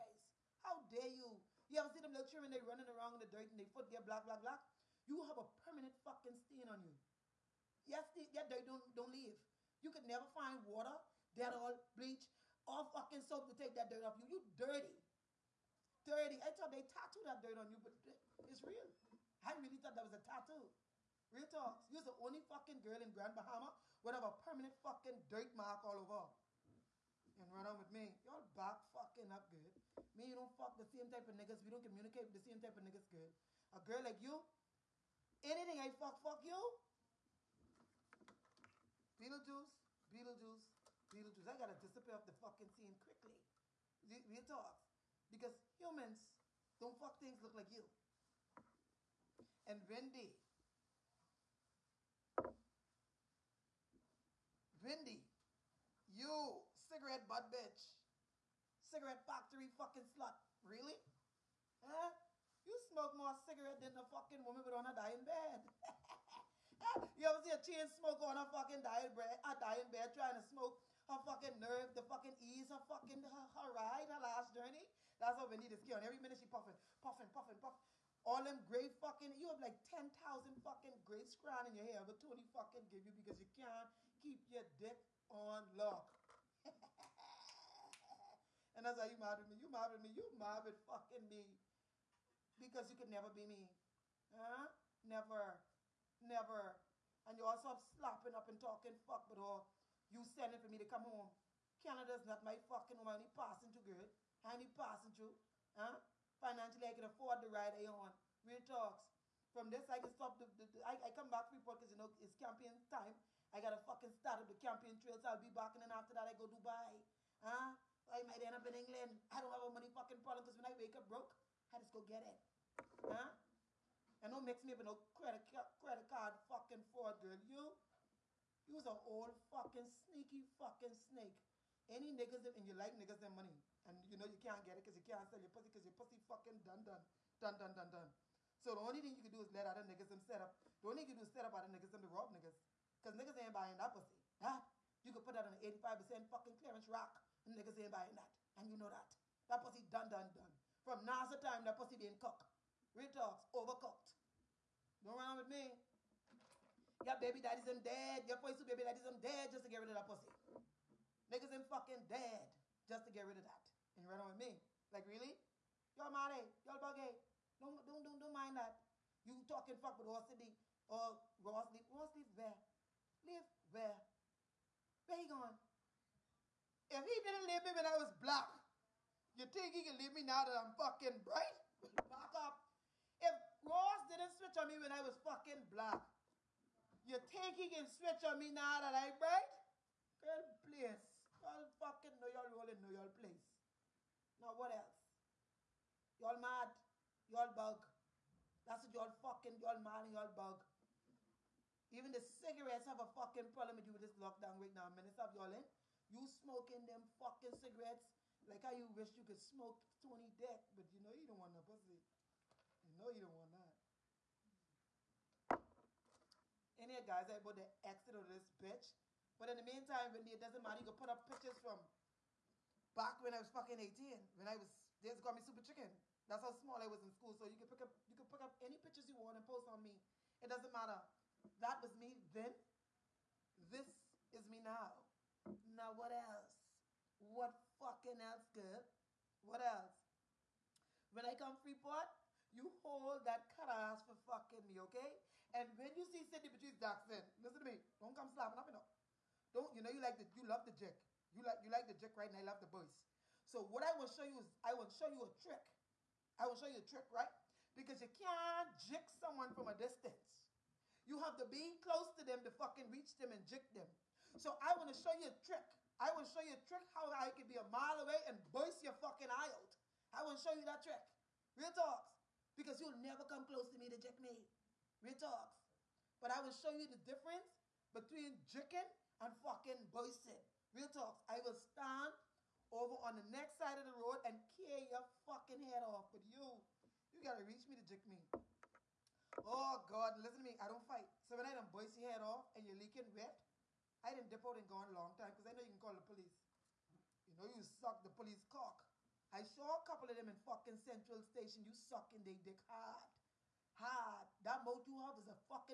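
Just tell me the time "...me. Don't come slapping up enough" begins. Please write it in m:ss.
4:07.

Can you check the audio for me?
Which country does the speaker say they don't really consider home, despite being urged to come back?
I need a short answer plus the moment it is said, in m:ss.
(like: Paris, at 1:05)
Canada, at 1:41.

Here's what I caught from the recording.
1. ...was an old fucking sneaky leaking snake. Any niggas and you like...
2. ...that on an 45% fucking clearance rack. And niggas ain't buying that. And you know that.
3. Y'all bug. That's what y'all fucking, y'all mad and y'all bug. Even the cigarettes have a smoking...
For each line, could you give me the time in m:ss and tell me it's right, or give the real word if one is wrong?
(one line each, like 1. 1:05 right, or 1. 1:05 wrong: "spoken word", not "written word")
1. 2:08 wrong: "fucking", not "leaking"
2. 2:25 wrong: "85", not "45"
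3. 3:17 wrong: "fucking", not "smoking".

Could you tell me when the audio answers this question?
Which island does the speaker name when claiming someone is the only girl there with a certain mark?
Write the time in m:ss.
0:23.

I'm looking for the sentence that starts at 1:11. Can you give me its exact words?
her fucking nerve, the fucking ease, her fucking her, her ride, her last journey.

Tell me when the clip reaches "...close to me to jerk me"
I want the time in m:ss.
4:33.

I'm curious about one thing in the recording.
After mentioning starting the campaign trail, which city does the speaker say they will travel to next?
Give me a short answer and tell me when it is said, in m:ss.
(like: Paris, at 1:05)
Dubai, at 1:56.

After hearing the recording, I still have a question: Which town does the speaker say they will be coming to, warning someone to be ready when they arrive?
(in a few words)
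Freeport.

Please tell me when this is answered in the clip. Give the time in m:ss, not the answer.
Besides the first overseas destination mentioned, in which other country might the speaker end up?
1:58.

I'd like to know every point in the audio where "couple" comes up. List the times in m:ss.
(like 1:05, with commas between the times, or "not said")
4:59.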